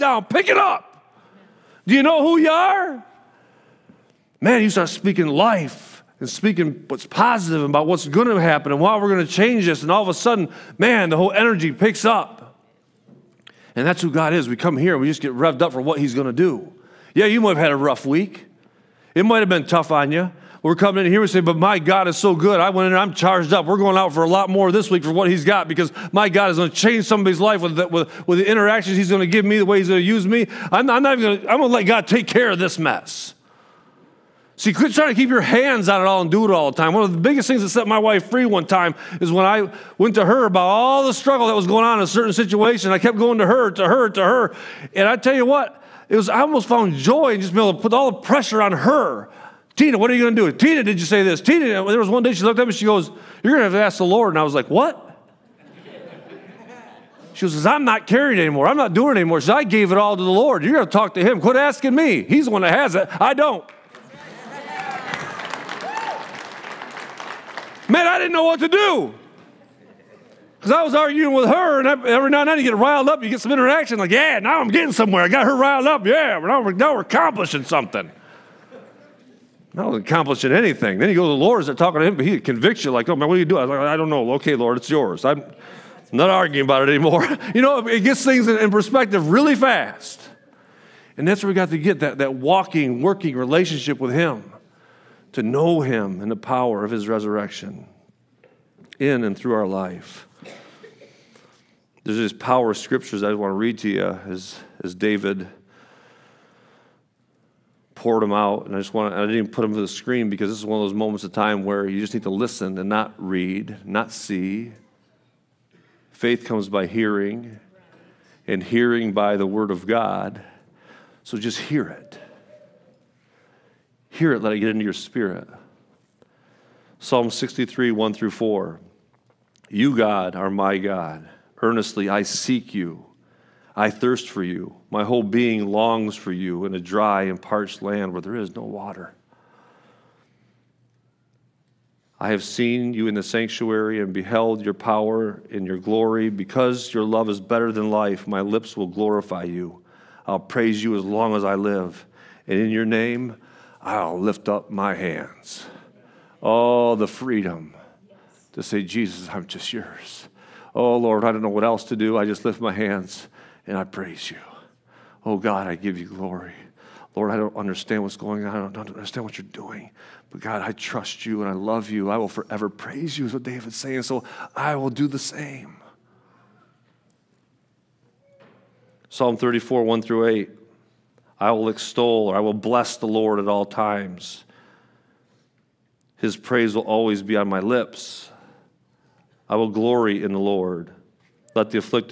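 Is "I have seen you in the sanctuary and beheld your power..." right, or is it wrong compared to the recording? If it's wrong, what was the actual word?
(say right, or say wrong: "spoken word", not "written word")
right.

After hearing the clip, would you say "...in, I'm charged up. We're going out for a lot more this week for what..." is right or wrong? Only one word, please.
right.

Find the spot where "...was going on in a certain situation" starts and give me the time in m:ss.
0:41.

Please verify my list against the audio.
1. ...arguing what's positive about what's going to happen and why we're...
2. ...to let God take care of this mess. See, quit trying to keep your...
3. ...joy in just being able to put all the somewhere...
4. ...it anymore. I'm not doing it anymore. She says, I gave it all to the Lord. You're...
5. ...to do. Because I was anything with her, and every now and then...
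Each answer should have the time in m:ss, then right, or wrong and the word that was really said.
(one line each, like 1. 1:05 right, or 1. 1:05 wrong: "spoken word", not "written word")
1. 0:06 wrong: "speaking", not "arguing"
2. 0:31 right
3. 0:46 wrong: "pressure", not "somewhere"
4. 0:58 right
5. 1:08 wrong: "arguing", not "anything".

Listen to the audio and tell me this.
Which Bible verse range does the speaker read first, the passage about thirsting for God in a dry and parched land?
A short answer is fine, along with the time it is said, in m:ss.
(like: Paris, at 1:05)
Psalm 63:1-4, at 2:06.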